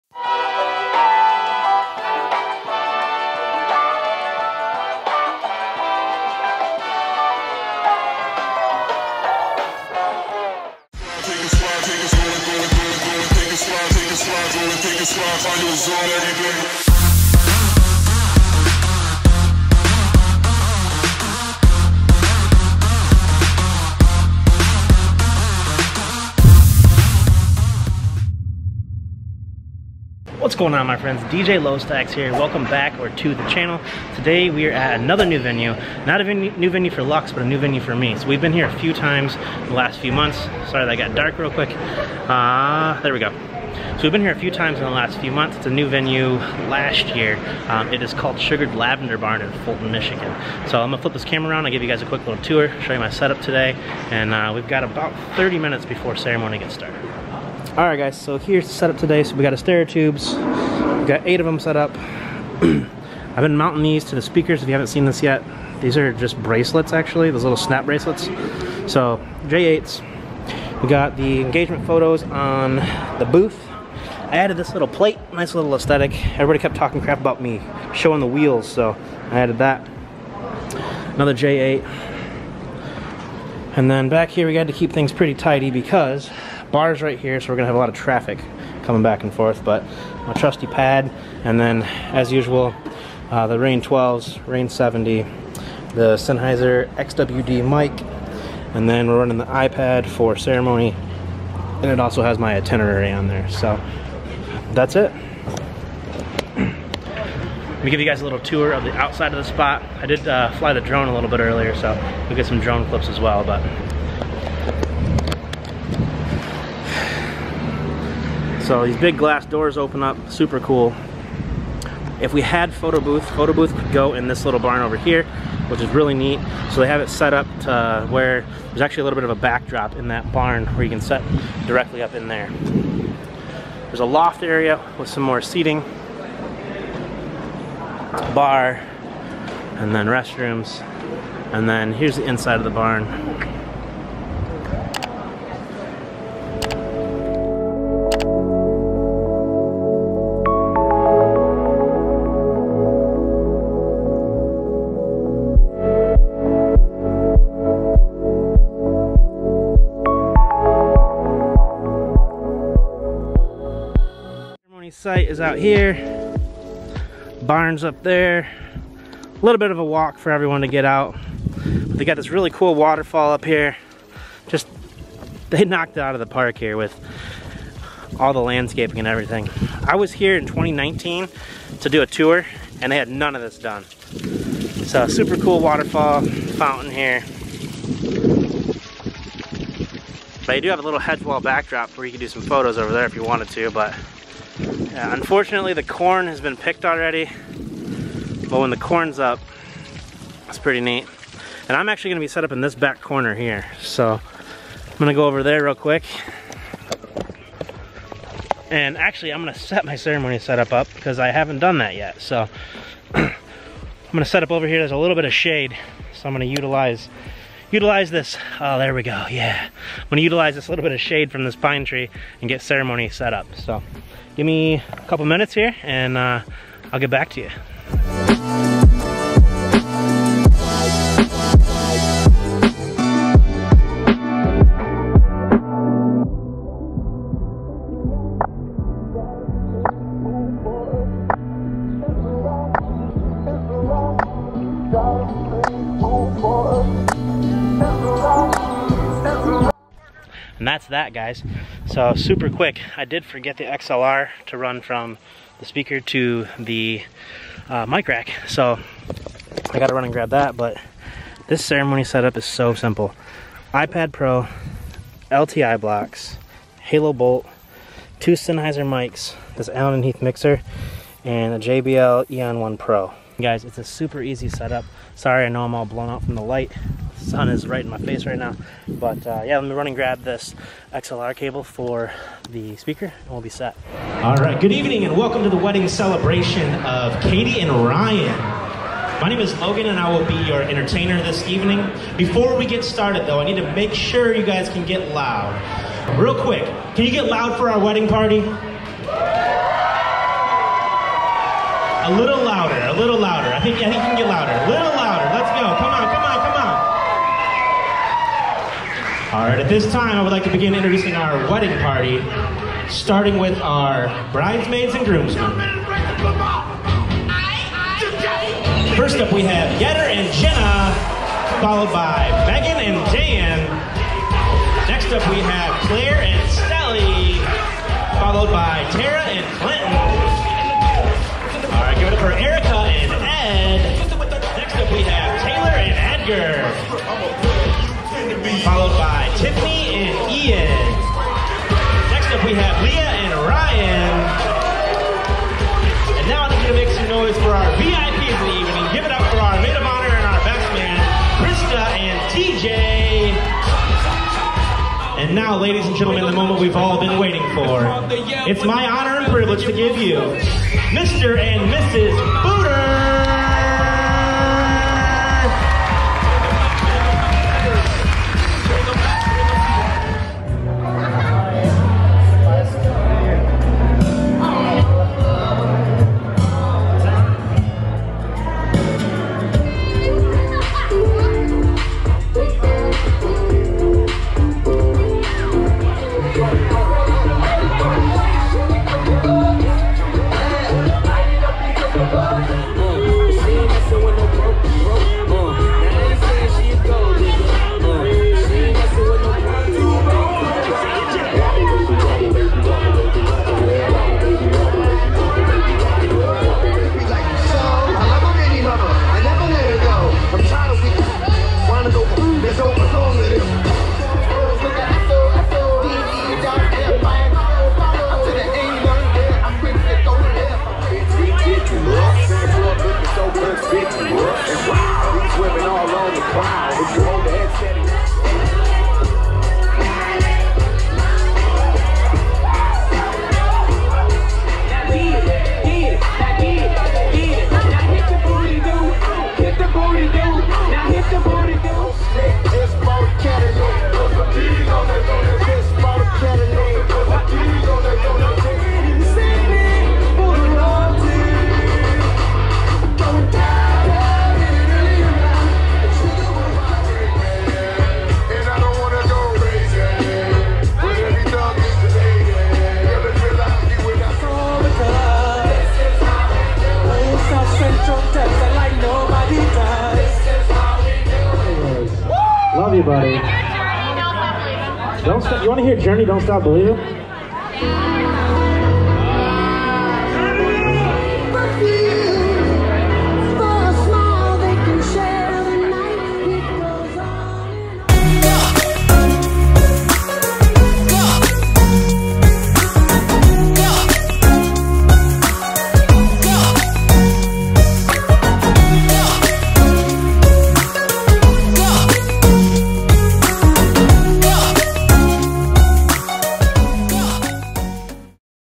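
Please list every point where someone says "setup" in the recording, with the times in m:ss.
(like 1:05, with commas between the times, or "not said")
0:53, 0:58, 3:30, 4:22, 4:34.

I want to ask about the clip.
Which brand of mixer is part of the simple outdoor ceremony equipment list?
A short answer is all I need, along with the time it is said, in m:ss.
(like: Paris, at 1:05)
Allen and Heath, at 4:29.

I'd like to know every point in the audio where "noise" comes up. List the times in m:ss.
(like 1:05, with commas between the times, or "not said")
5:47.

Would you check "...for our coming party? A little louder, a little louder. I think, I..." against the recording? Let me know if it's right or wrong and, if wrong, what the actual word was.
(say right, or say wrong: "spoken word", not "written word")
wrong: "wedding", not "coming".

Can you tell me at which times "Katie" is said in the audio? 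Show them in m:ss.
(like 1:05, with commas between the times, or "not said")
4:47.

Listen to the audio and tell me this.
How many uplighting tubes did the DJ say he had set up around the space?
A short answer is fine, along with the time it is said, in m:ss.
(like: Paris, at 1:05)
8, at 1:01.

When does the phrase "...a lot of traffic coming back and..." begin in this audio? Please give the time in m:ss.
1:27.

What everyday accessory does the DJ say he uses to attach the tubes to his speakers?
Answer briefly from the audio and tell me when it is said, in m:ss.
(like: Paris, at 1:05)
snap bracelets, at 1:07.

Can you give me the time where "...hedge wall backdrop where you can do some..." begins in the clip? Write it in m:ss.
3:10.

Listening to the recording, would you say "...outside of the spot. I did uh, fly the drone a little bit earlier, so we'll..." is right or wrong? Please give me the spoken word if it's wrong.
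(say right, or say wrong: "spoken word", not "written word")
right.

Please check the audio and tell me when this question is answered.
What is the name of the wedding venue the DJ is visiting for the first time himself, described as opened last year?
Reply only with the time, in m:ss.
0:48.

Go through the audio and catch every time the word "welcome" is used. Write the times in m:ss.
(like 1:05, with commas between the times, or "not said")
0:32, 4:45.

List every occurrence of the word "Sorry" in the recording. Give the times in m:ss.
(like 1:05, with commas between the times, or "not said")
0:40, 4:35.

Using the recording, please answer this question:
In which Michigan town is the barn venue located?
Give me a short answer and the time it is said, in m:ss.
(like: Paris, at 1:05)
Fulton, at 0:49.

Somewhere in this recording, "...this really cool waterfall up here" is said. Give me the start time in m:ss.
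2:52.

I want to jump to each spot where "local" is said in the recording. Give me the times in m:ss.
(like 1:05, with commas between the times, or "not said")
not said.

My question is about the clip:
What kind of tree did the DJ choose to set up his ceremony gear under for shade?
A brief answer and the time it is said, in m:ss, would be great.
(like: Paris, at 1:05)
pine tree, at 3:41.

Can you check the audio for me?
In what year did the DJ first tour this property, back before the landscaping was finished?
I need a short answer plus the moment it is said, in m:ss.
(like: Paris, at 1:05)
2019, at 3:00.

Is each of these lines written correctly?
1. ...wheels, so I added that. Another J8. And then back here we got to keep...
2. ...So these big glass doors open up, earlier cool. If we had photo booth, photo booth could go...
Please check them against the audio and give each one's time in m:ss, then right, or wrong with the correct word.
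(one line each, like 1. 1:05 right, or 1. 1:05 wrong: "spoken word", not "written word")
1. 1:18 right
2. 1:58 wrong: "super", not "earlier".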